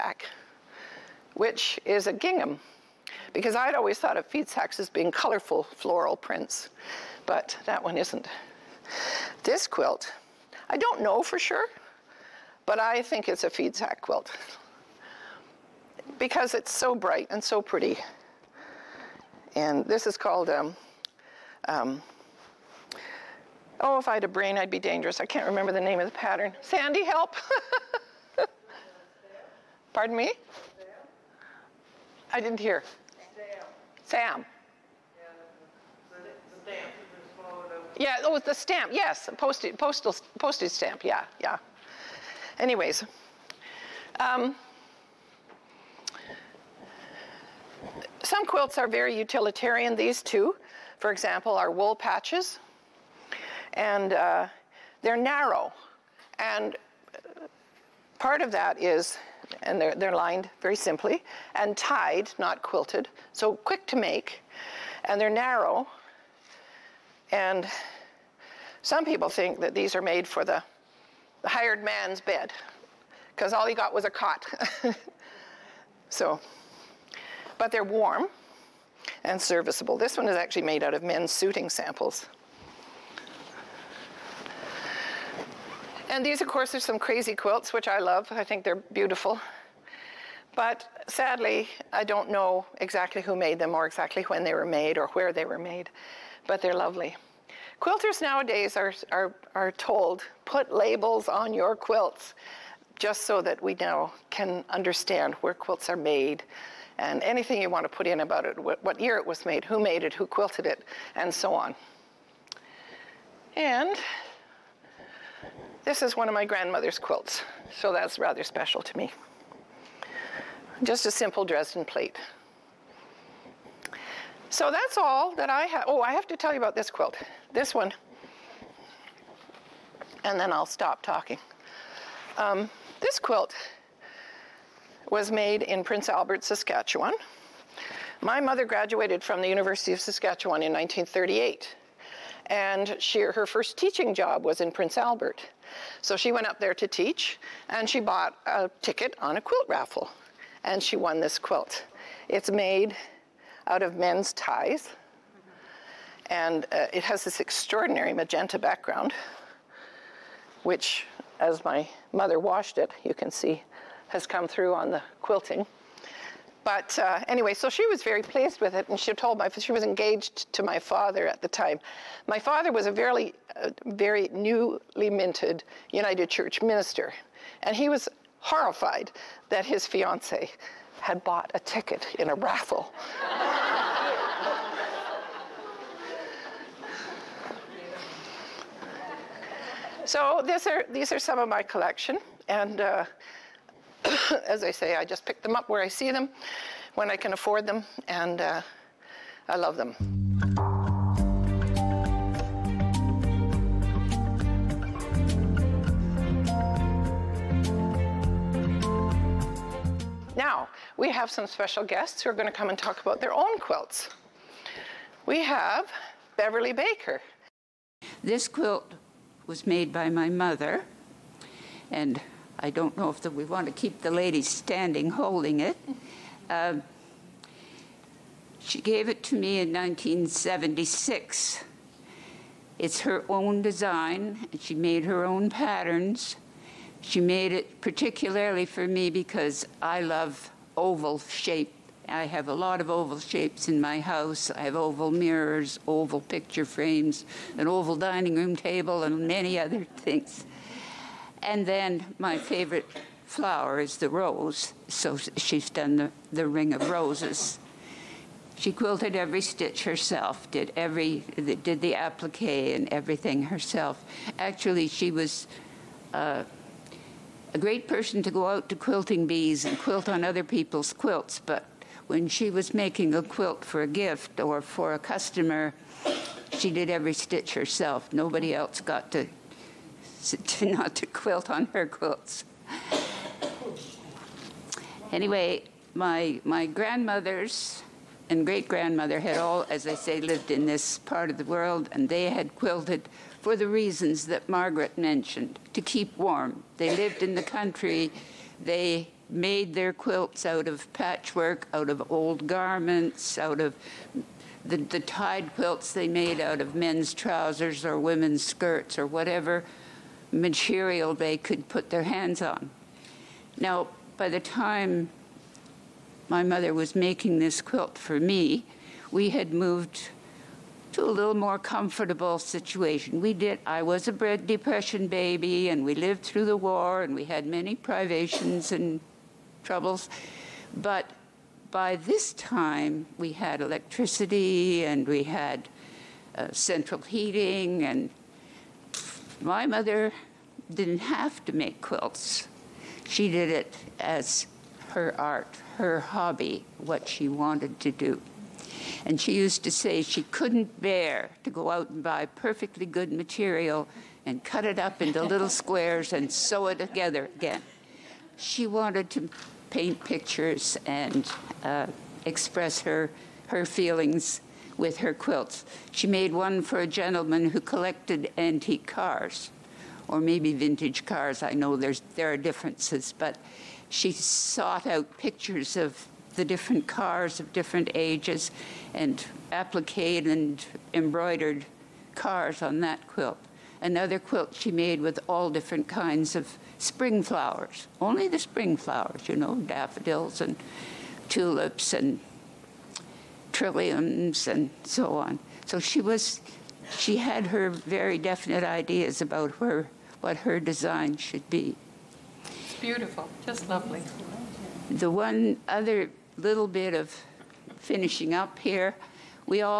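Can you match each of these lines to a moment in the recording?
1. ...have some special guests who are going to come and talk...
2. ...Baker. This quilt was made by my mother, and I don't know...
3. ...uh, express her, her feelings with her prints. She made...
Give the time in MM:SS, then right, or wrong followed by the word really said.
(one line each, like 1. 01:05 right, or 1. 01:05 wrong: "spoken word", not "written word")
1. 03:31 right
2. 03:36 right
3. 06:01 wrong: "quilts", not "prints".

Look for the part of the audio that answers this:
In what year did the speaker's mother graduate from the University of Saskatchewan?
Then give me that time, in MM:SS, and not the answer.
02:20.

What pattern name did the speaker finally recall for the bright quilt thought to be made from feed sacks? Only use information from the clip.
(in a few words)
Postage stamp.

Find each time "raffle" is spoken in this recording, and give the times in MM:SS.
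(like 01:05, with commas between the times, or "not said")
02:29, 03:02.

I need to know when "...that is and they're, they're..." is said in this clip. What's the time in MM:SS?
00:58.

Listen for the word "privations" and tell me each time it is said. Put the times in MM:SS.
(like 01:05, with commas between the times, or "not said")
05:27.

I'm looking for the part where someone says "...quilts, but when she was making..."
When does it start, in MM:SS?
04:30.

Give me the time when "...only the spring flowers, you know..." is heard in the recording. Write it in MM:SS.
06:28.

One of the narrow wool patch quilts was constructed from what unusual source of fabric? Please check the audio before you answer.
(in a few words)
Men's suiting samples.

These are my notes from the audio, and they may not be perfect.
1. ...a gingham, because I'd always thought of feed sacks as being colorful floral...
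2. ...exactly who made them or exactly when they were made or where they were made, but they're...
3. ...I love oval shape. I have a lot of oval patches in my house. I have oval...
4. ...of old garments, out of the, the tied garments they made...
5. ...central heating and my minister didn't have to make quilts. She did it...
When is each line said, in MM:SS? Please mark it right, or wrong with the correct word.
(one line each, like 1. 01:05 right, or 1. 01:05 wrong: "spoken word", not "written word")
1. 00:02 right
2. 01:32 right
3. 03:59 wrong: "shapes", not "patches"
4. 05:01 wrong: "quilts", not "garments"
5. 05:36 wrong: "mother", not "minister".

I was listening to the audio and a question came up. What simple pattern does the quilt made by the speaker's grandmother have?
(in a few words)
Dresden plate.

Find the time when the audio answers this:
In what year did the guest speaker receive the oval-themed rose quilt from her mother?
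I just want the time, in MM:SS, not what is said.
03:49.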